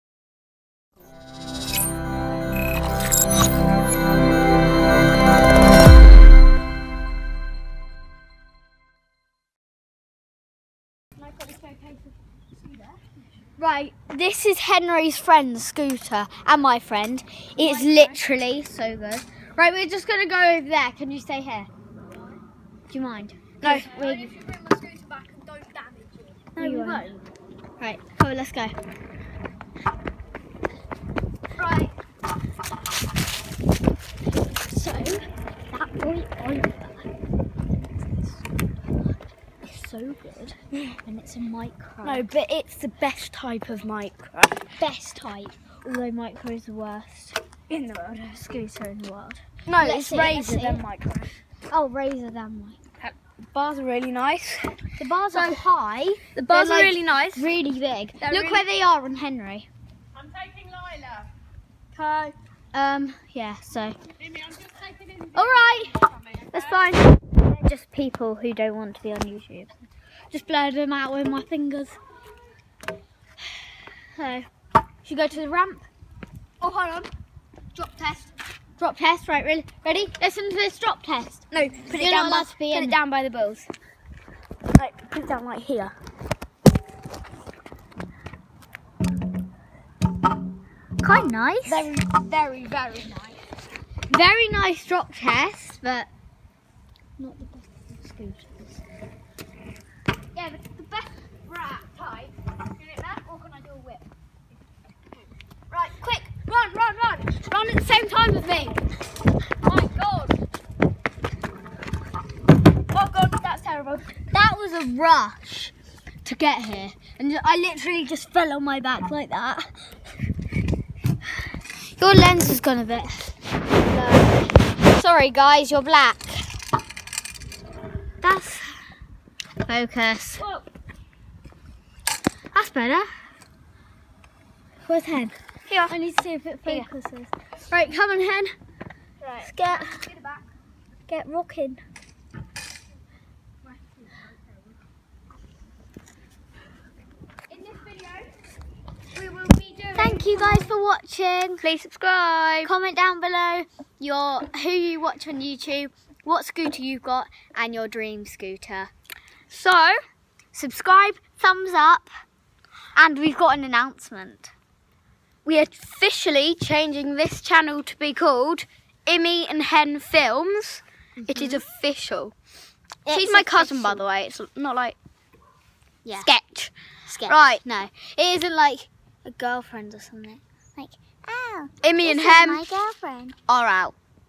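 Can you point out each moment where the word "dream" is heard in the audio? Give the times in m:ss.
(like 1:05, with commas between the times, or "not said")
2:37.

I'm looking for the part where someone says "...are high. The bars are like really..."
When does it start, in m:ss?
0:55.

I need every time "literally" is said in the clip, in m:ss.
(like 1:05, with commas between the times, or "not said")
0:17, 1:57.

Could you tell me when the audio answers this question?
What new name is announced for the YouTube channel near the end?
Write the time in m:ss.
2:49.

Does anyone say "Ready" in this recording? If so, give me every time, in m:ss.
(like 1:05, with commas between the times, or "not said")
1:19.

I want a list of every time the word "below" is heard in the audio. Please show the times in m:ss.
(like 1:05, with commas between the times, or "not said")
2:33.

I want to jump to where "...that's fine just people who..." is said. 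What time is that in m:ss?
1:06.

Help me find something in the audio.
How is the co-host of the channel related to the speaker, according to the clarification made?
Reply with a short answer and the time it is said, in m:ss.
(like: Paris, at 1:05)
Cousin, at 2:53.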